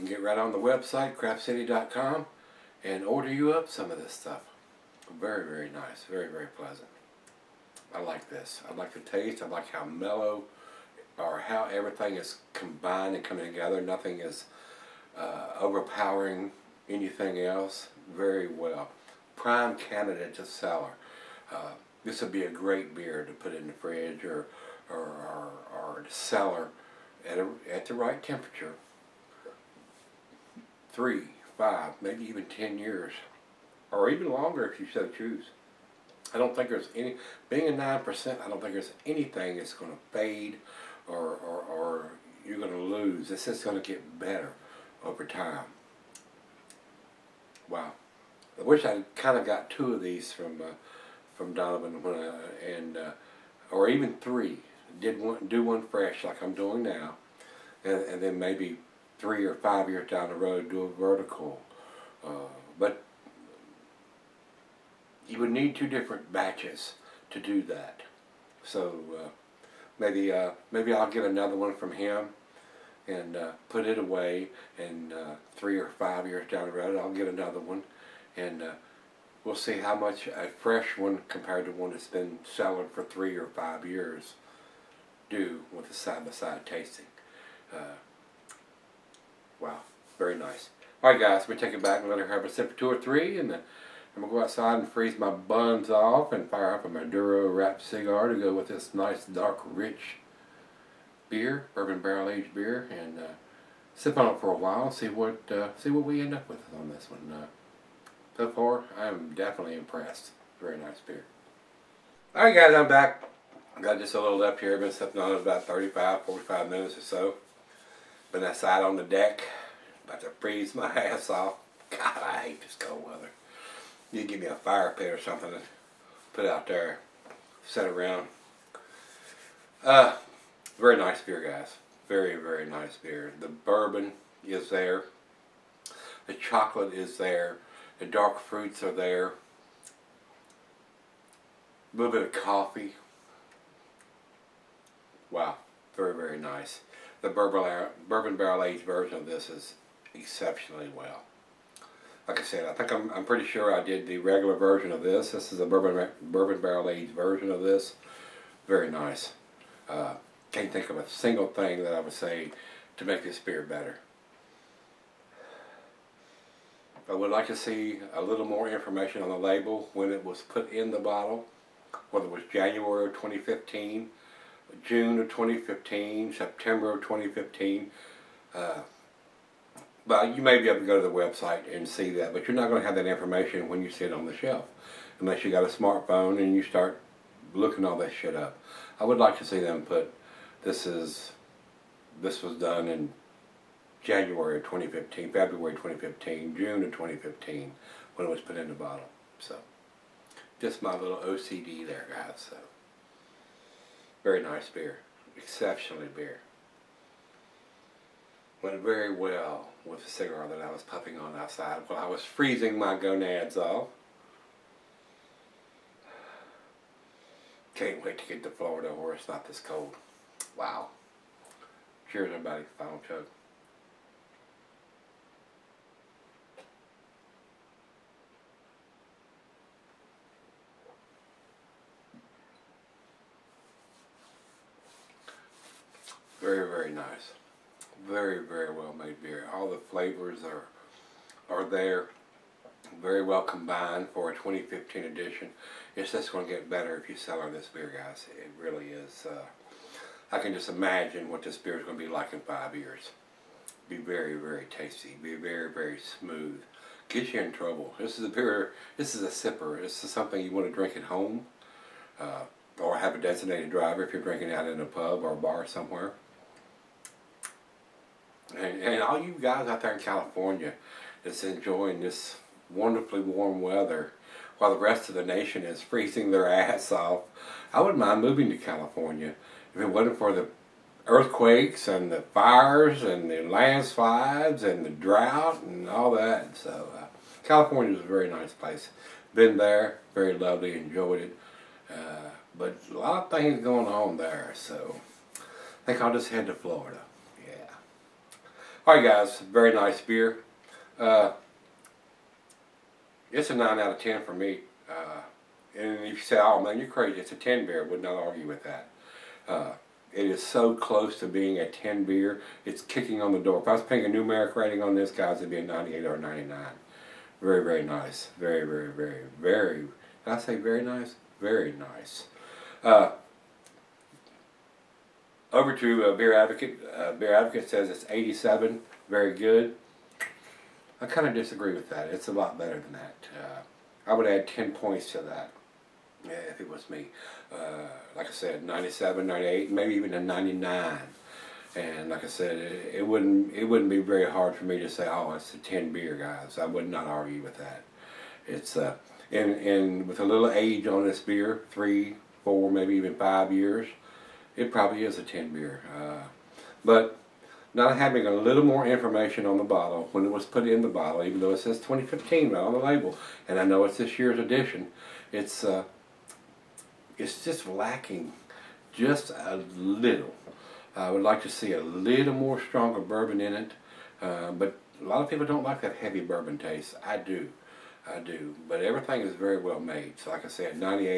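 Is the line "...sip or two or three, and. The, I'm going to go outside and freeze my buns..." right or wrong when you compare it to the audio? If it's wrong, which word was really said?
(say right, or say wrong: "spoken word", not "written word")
right.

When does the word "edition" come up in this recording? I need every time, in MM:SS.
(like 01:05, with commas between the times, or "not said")
04:05, 06:04.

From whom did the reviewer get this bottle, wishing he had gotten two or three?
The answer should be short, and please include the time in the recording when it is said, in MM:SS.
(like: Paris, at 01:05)
Donovan, at 00:51.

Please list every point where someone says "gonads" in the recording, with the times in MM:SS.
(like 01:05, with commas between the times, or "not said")
03:32.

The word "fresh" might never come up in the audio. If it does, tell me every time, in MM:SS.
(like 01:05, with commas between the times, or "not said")
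00:55, 01:20.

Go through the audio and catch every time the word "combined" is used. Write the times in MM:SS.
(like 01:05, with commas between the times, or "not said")
00:12, 04:03.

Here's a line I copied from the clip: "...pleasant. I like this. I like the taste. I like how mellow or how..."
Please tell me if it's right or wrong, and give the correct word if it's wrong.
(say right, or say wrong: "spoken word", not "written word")
right.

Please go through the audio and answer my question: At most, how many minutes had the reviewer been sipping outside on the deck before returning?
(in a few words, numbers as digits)
45.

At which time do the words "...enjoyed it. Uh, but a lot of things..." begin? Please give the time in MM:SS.
04:50.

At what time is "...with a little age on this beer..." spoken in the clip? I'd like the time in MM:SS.
05:50.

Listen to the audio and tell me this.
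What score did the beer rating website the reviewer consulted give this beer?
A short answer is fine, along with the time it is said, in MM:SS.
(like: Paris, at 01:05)
87, at 05:28.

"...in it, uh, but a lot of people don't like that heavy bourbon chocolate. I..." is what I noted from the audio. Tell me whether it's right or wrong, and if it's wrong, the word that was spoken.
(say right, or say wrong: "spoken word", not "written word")
wrong: "taste", not "chocolate".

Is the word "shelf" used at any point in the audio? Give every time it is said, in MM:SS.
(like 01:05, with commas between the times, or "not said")
03:04.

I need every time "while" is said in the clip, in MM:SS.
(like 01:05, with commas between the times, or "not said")
01:44, 03:31, 04:34.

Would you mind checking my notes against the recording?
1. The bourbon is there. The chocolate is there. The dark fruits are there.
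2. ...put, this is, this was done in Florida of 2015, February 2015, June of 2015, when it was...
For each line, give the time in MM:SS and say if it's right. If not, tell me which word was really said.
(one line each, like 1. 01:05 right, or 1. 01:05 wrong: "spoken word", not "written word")
1. 02:13 right
2. 03:09 wrong: "January", not "Florida".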